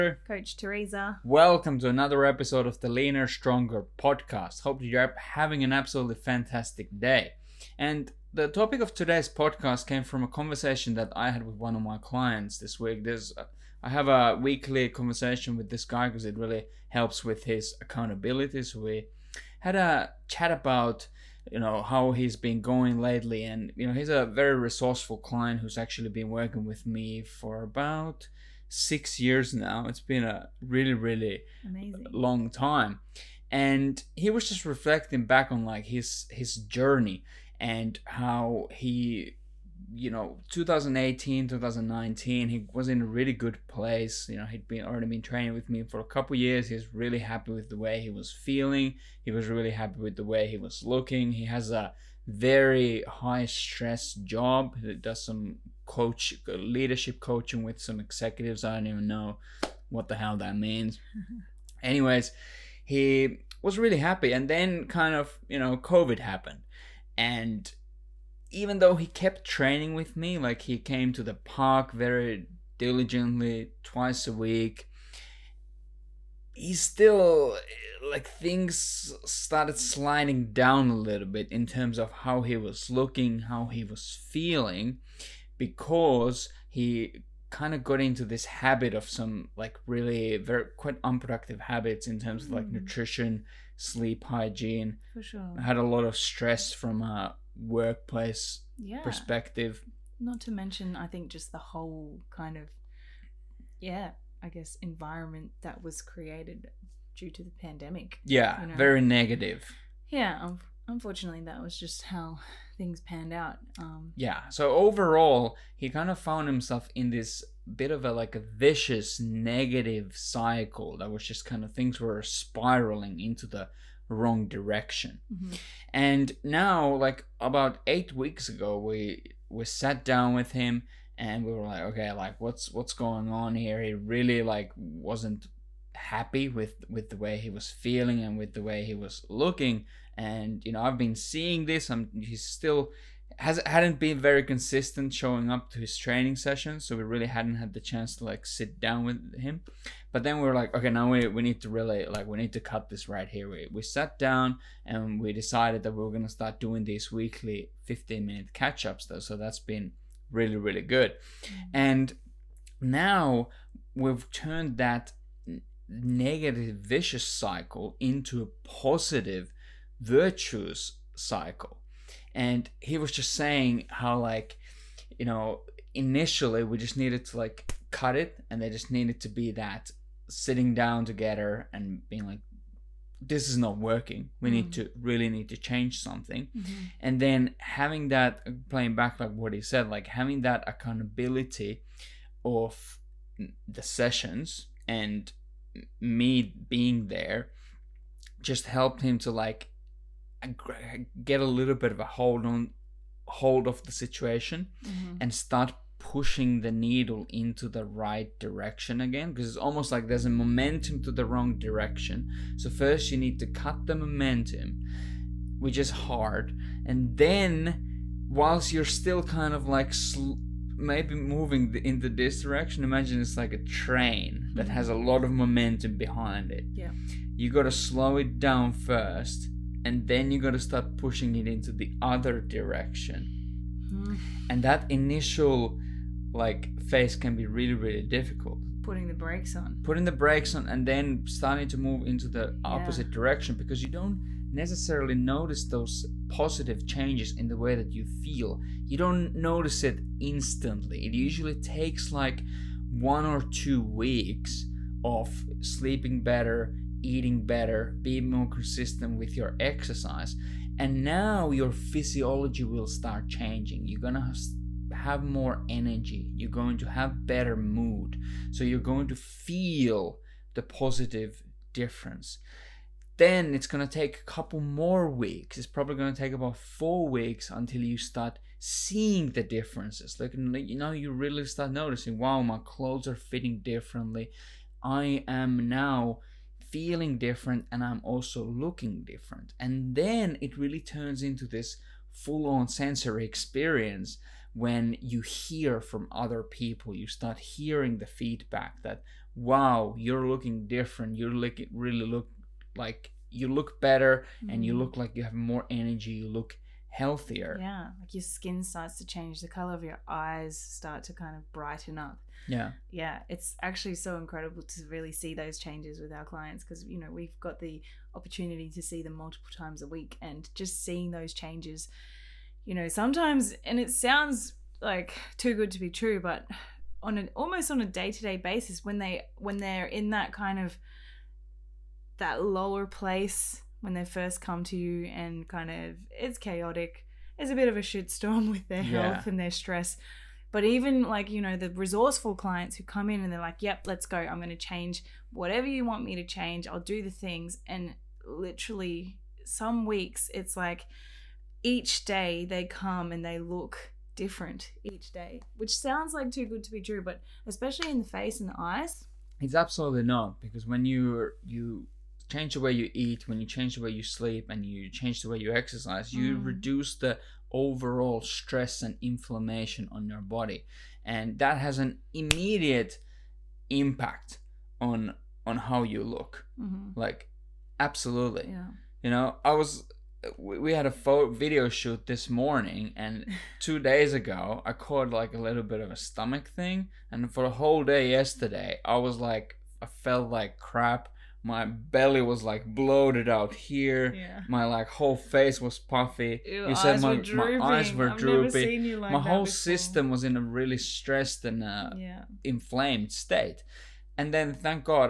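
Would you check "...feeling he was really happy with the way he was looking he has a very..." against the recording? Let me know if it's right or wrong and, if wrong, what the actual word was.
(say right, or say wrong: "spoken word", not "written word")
right.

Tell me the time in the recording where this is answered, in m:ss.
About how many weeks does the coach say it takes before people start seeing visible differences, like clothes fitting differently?
4:36.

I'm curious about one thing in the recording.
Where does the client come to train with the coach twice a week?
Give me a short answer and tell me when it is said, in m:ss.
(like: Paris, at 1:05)
the park, at 1:11.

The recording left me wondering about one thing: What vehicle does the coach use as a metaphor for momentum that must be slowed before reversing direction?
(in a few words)
a train.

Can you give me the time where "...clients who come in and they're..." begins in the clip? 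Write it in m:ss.
5:42.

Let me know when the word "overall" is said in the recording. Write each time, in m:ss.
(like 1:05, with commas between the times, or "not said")
1:54, 6:07.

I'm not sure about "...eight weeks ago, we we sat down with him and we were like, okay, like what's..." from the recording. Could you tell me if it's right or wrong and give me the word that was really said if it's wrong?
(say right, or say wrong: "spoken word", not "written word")
right.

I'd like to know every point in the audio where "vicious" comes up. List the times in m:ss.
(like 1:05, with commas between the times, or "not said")
1:58, 2:46.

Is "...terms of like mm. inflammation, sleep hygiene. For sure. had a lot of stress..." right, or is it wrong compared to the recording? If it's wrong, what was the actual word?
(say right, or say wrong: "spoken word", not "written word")
wrong: "nutrition", not "inflammation".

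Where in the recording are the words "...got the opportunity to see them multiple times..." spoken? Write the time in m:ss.
5:17.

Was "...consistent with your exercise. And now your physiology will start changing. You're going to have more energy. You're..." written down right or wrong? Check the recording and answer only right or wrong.
right.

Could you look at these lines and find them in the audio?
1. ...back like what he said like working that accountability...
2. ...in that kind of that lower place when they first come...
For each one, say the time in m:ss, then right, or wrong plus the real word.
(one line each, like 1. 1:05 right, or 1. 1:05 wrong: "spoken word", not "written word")
1. 3:08 wrong: "having", not "working"
2. 5:29 right.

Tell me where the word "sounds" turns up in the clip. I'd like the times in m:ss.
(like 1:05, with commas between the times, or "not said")
5:23, 5:55.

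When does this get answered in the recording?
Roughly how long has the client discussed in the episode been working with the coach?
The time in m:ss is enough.
0:28.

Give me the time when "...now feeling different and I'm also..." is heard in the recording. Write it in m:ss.
4:45.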